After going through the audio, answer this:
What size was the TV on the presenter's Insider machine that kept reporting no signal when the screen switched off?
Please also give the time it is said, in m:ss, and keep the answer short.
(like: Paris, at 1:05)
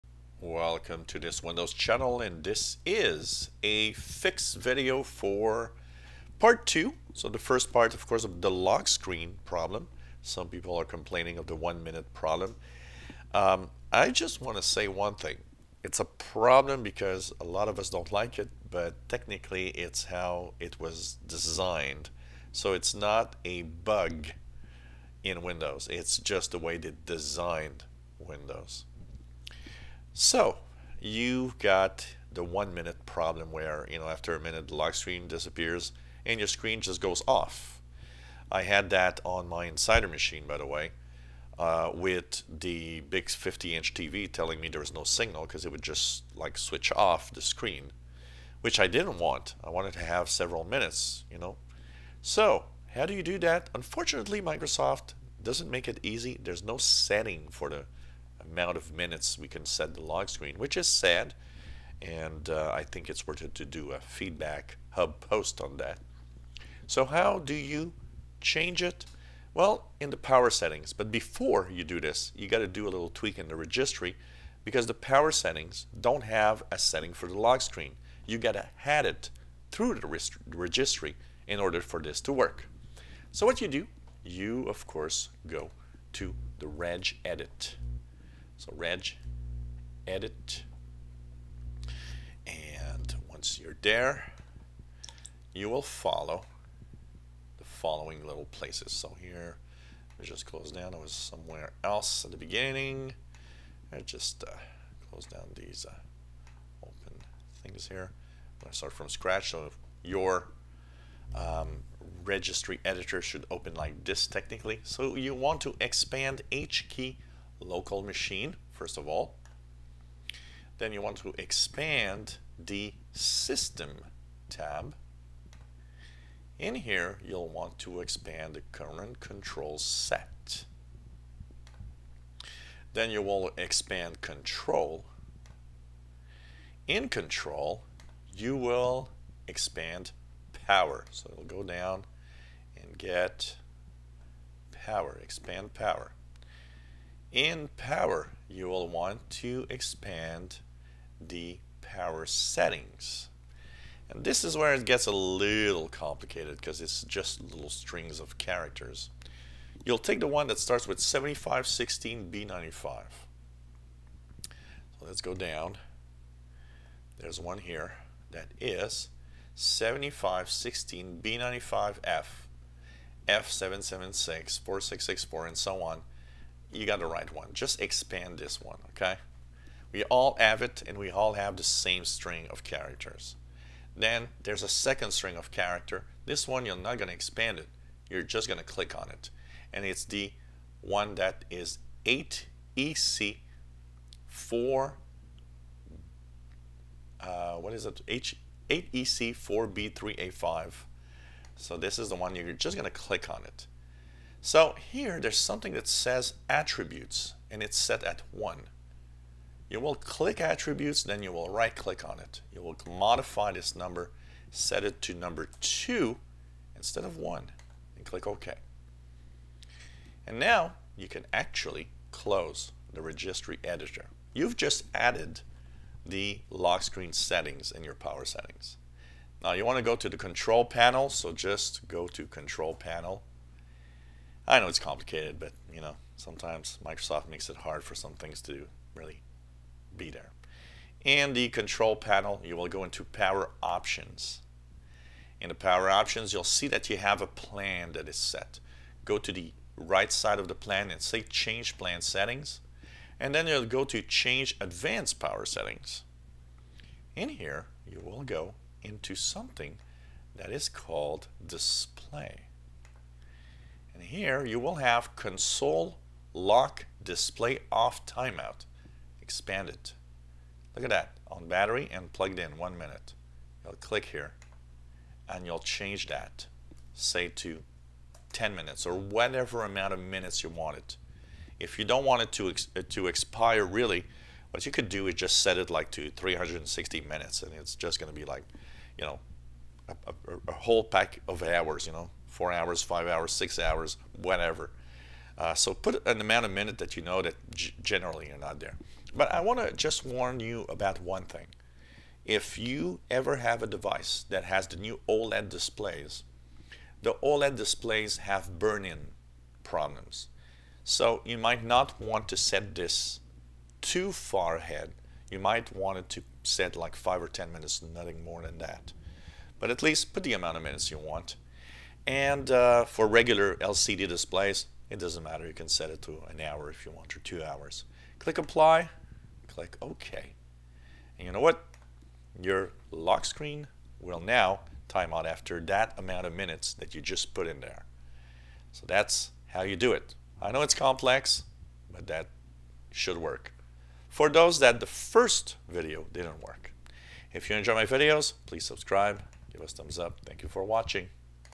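50 inch, at 0:43.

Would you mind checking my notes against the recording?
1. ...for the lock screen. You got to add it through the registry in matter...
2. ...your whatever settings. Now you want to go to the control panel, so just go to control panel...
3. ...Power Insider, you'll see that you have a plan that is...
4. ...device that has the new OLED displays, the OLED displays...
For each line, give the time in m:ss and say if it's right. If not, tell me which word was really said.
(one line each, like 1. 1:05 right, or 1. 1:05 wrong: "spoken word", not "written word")
1. 1:17 wrong: "order", not "matter"
2. 3:47 wrong: "power", not "whatever"
3. 4:05 wrong: "Options", not "Insider"
4. 5:03 right.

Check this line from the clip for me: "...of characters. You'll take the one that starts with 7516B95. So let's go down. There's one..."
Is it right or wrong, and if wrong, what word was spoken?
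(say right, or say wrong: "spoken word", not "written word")
right.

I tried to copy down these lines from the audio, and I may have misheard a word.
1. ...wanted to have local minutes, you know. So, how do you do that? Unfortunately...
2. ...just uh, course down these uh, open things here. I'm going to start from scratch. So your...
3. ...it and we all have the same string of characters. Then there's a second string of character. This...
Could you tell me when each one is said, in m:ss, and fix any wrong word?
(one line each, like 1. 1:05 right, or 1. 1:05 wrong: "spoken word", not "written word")
1. 0:49 wrong: "several", not "local"
2. 1:44 wrong: "close", not "course"
3. 3:00 right.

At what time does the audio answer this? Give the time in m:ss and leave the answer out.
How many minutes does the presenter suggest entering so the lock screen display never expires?
4:46.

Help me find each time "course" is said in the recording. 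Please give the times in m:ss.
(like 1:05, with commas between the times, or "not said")
0:08, 1:24.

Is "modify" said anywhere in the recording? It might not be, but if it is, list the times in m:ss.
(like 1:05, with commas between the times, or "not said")
3:32.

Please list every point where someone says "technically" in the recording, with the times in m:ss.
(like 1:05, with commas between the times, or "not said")
0:19, 1:54.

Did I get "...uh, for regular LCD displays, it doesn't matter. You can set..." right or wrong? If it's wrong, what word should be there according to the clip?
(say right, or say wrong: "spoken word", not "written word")
right.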